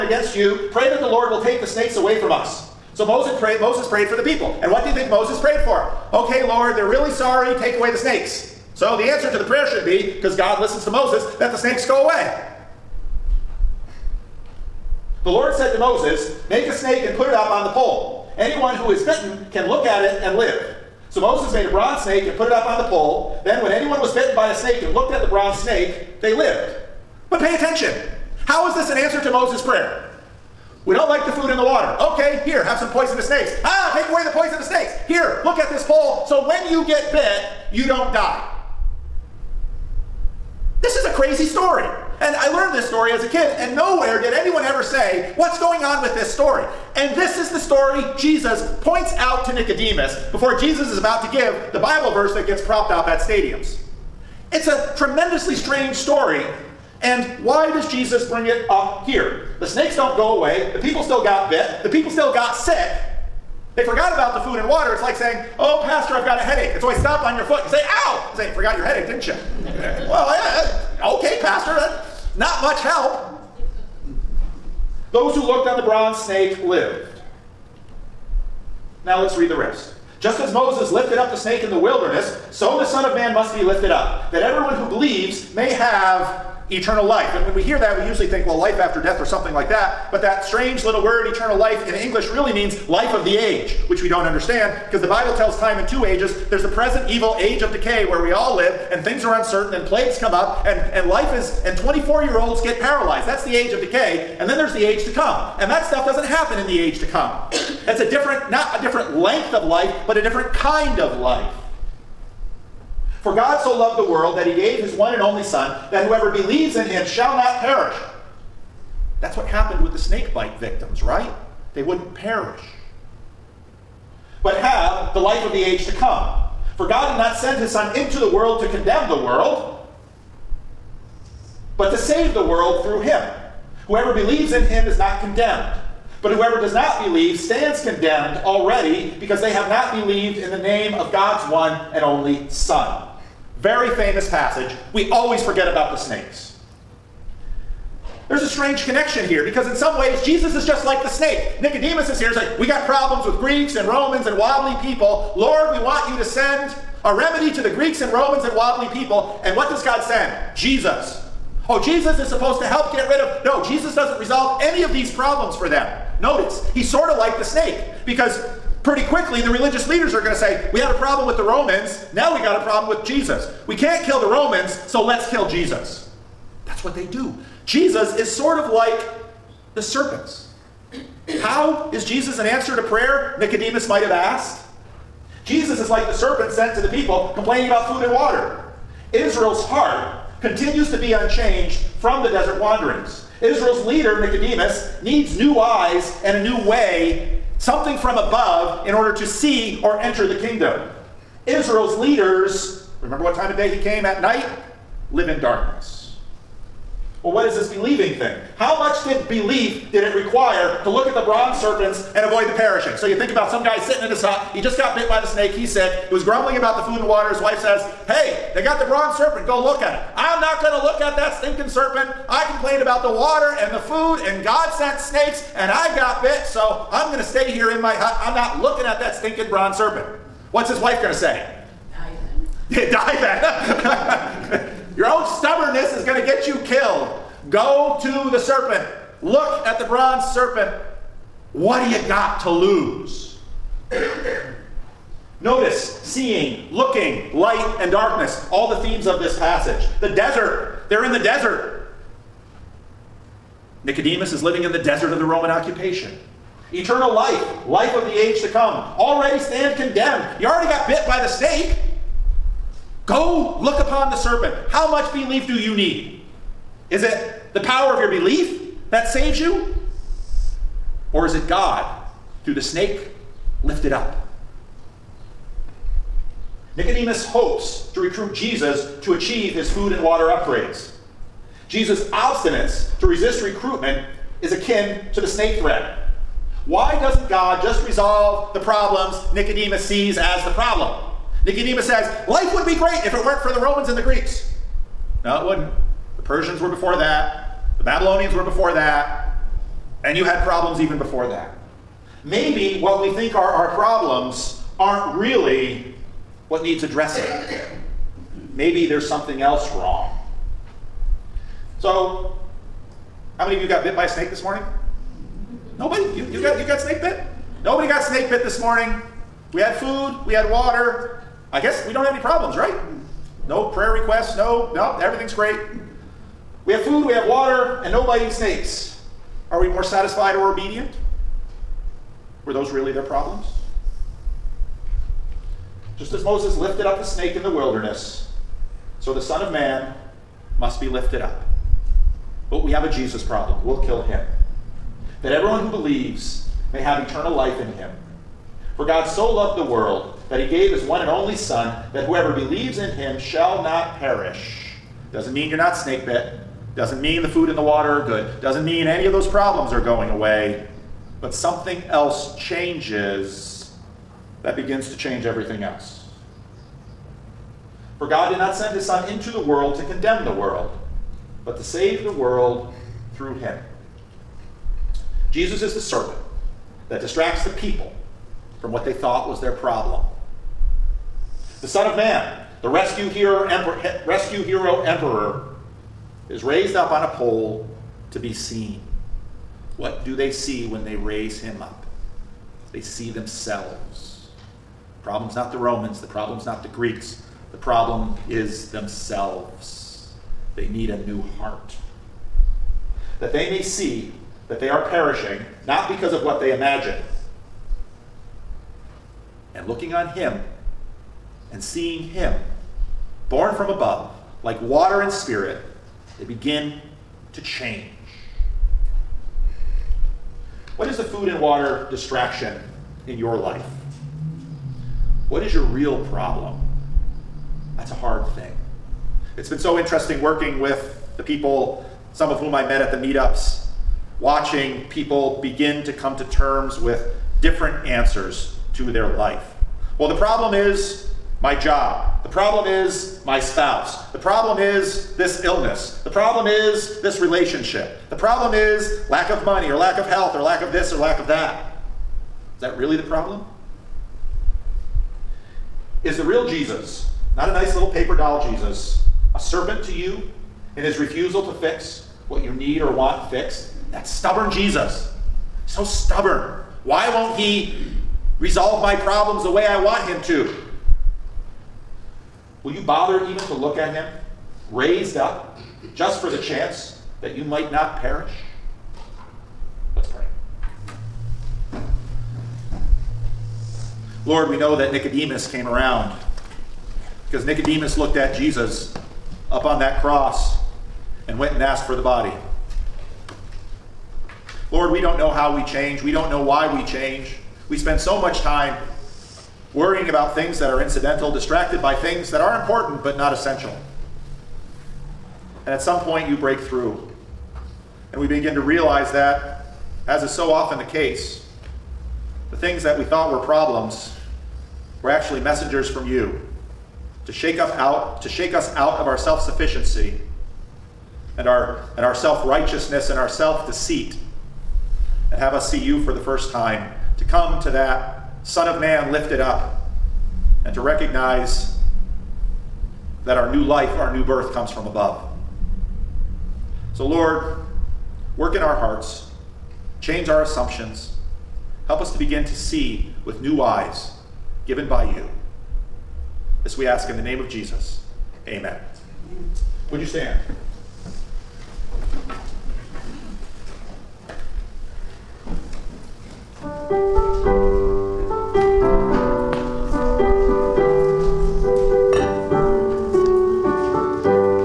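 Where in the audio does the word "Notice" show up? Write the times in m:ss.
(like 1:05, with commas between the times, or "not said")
2:46, 4:05.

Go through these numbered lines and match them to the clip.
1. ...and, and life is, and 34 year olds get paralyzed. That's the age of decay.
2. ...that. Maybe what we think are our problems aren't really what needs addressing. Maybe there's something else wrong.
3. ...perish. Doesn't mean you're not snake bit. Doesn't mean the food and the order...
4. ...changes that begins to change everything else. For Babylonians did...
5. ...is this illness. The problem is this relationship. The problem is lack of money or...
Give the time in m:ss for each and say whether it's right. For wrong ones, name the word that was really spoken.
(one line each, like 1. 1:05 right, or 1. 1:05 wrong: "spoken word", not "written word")
1. 1:40 wrong: "24", not "34"
2. 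5:01 right
3. 5:53 wrong: "water", not "order"
4. 6:02 wrong: "God", not "Babylonians"
5. 7:24 right.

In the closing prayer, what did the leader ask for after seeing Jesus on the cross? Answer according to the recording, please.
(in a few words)
The body.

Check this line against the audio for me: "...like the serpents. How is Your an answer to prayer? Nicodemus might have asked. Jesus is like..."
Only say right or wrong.
wrong.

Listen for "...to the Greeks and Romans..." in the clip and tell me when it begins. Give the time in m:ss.
2:37.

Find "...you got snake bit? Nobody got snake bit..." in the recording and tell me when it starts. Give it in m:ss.
5:16.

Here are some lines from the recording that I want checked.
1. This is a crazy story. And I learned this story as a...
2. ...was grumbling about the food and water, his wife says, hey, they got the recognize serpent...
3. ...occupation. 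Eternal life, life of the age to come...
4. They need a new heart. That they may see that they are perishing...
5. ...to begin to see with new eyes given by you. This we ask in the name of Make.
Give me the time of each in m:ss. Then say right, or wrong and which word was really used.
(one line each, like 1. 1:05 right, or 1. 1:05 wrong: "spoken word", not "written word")
1. 0:40 right
2. 3:36 wrong: "bronze", not "recognize"
3. 4:15 right
4. 6:40 right
5. 9:02 wrong: "Jesus", not "Make".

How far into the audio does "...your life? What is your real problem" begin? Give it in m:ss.
7:03.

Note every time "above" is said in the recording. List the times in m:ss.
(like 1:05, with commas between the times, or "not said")
3:18, 6:53, 8:54.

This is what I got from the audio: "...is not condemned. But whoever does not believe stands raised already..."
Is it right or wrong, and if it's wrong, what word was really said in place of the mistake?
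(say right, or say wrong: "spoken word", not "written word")
wrong: "condemned", not "raised".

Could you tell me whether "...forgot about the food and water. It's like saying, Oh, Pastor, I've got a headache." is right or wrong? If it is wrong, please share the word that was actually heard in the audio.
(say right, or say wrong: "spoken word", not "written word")
right.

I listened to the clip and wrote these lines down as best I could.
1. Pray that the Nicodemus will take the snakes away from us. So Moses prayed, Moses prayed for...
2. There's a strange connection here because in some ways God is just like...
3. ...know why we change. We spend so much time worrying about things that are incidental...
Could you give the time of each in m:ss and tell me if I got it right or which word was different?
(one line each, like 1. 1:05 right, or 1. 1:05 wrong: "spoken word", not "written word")
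1. 0:00 wrong: "Lord", not "Nicodemus"
2. 2:28 wrong: "Jesus", not "God"
3. 8:16 right.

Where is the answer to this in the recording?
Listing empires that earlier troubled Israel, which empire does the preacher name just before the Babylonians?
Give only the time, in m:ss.
4:56.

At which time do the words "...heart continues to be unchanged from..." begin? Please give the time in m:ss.
3:09.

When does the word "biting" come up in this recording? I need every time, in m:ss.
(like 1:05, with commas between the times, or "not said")
5:28.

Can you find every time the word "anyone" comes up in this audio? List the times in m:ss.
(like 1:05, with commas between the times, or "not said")
0:18, 0:23, 0:44.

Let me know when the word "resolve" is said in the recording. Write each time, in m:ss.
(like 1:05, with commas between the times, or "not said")
2:44, 4:47, 7:48.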